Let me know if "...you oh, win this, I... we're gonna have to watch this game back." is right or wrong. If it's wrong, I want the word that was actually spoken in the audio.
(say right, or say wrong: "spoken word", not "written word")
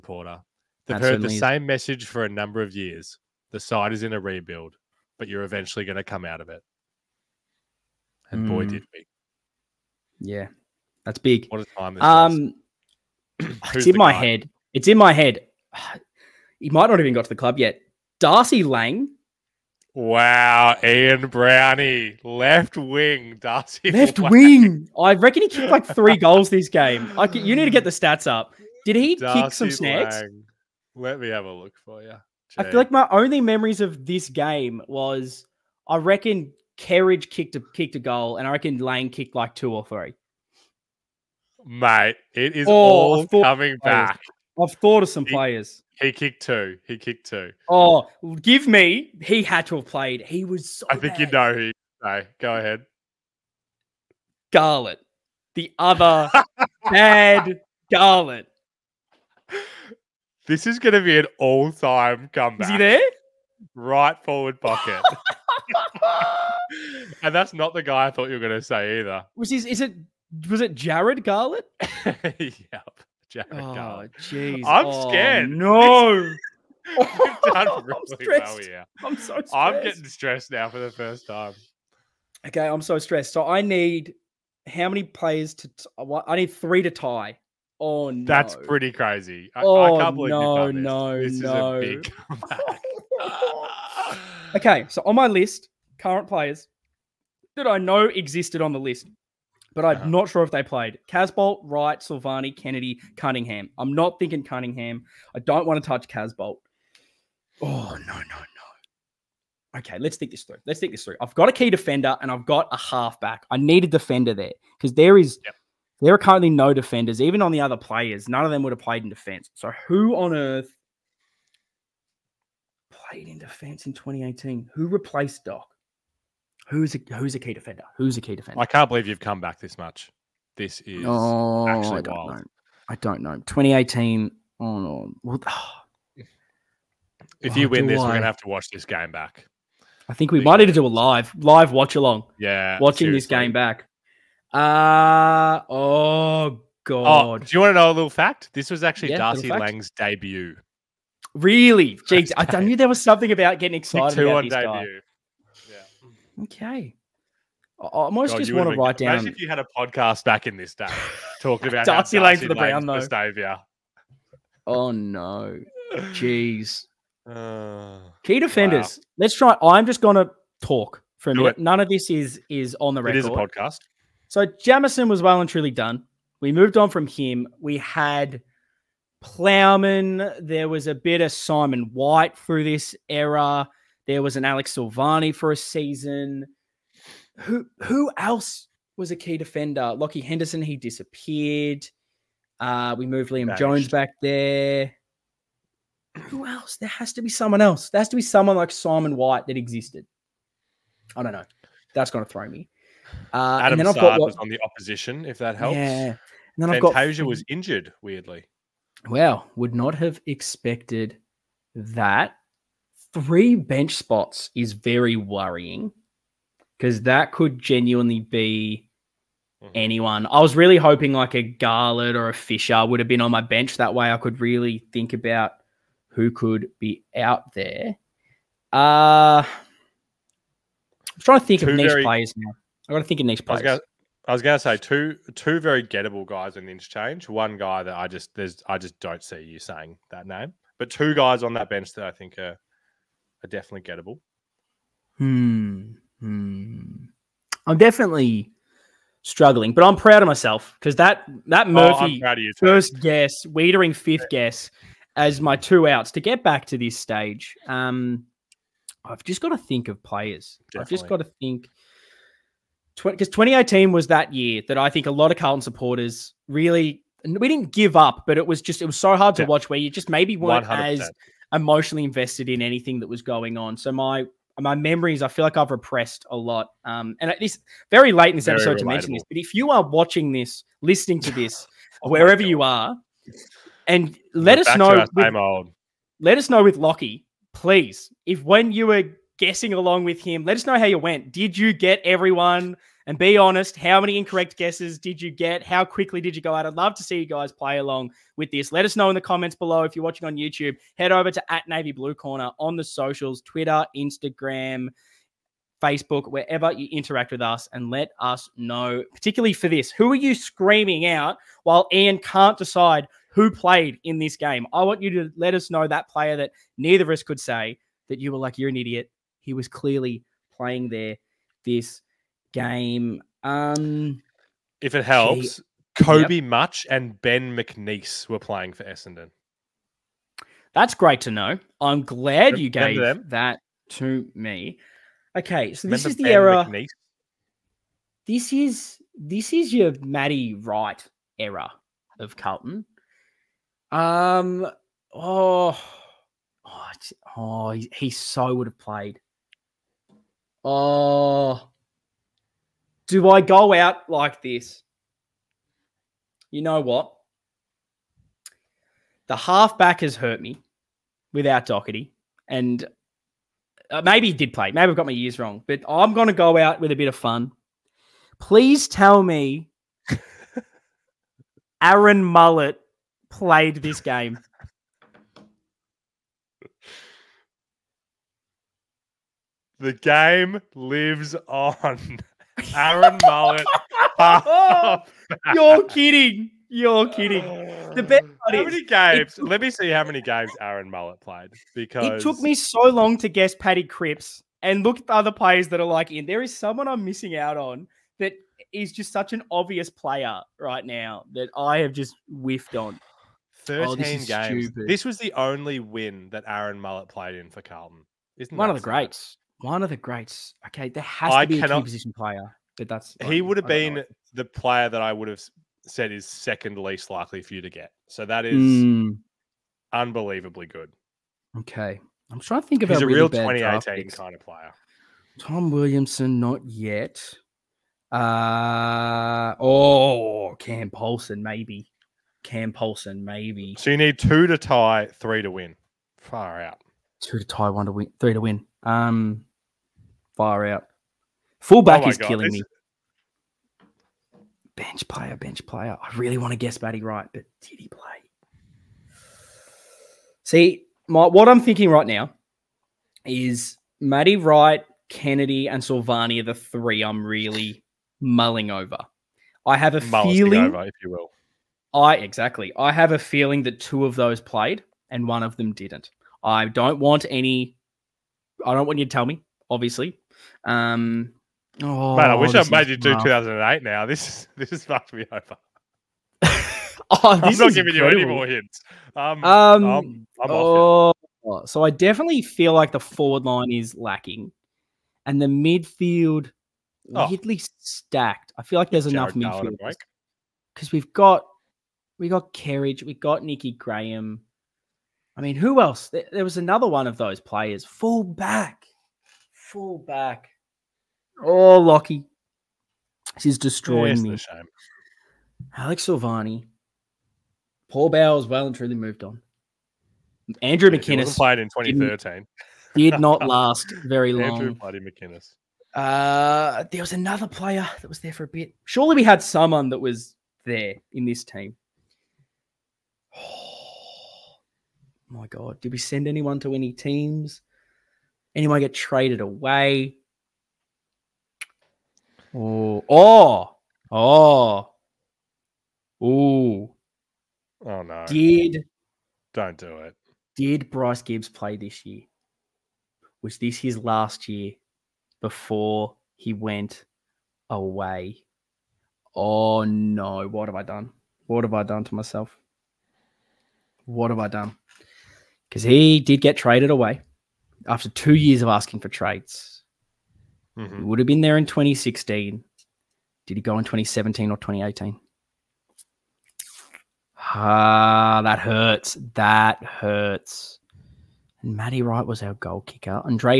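right.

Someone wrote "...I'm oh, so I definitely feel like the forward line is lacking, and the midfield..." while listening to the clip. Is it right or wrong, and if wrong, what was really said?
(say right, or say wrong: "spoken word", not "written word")
right.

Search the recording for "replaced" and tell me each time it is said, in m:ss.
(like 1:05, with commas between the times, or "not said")
2:04.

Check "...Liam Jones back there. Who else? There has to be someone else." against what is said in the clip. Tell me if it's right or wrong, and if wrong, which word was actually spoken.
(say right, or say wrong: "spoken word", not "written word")
right.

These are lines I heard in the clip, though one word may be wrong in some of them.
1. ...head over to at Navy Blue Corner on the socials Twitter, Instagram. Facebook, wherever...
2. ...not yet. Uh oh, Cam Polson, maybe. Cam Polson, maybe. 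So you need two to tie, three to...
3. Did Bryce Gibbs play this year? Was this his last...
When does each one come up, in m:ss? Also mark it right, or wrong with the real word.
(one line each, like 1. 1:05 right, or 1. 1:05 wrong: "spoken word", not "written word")
1. 5:00 right
2. 7:06 right
3. 9:00 right.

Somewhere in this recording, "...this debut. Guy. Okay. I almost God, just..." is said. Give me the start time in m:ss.
2:34.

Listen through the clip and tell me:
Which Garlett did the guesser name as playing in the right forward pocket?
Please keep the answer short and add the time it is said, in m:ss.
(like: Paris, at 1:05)
Jarrod Garlett, at 1:10.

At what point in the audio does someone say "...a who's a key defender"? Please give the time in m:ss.
2:06.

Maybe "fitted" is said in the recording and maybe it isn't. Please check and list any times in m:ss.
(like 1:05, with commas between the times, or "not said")
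not said.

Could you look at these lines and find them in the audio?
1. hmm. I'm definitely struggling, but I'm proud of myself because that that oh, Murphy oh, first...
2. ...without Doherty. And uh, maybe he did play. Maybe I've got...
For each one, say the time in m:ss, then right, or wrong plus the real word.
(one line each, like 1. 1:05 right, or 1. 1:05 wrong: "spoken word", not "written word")
1. 4:06 right
2. 6:01 right.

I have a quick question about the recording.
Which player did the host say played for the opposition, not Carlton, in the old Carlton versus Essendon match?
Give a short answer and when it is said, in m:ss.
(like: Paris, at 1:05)
Saad, at 3:23.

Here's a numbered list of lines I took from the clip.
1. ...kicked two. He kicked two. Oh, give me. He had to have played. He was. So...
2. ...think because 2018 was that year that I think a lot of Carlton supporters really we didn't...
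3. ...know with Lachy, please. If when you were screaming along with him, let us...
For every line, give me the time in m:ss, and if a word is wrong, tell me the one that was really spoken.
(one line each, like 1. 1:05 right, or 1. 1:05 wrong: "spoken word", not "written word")
1. 0:46 right
2. 4:21 right
3. 4:46 wrong: "guessing", not "screaming".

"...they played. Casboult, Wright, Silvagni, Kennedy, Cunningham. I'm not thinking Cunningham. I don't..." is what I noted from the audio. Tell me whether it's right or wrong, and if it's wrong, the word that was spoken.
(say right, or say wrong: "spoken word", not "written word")
right.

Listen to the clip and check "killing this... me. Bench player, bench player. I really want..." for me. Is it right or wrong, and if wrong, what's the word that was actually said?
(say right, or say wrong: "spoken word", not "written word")
right.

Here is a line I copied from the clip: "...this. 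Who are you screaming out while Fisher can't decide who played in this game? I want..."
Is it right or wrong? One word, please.
wrong.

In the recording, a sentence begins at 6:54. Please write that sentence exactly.
the player that I would have said is second least likely for you to get.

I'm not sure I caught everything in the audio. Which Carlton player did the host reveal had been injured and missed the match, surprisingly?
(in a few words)
Fantasia.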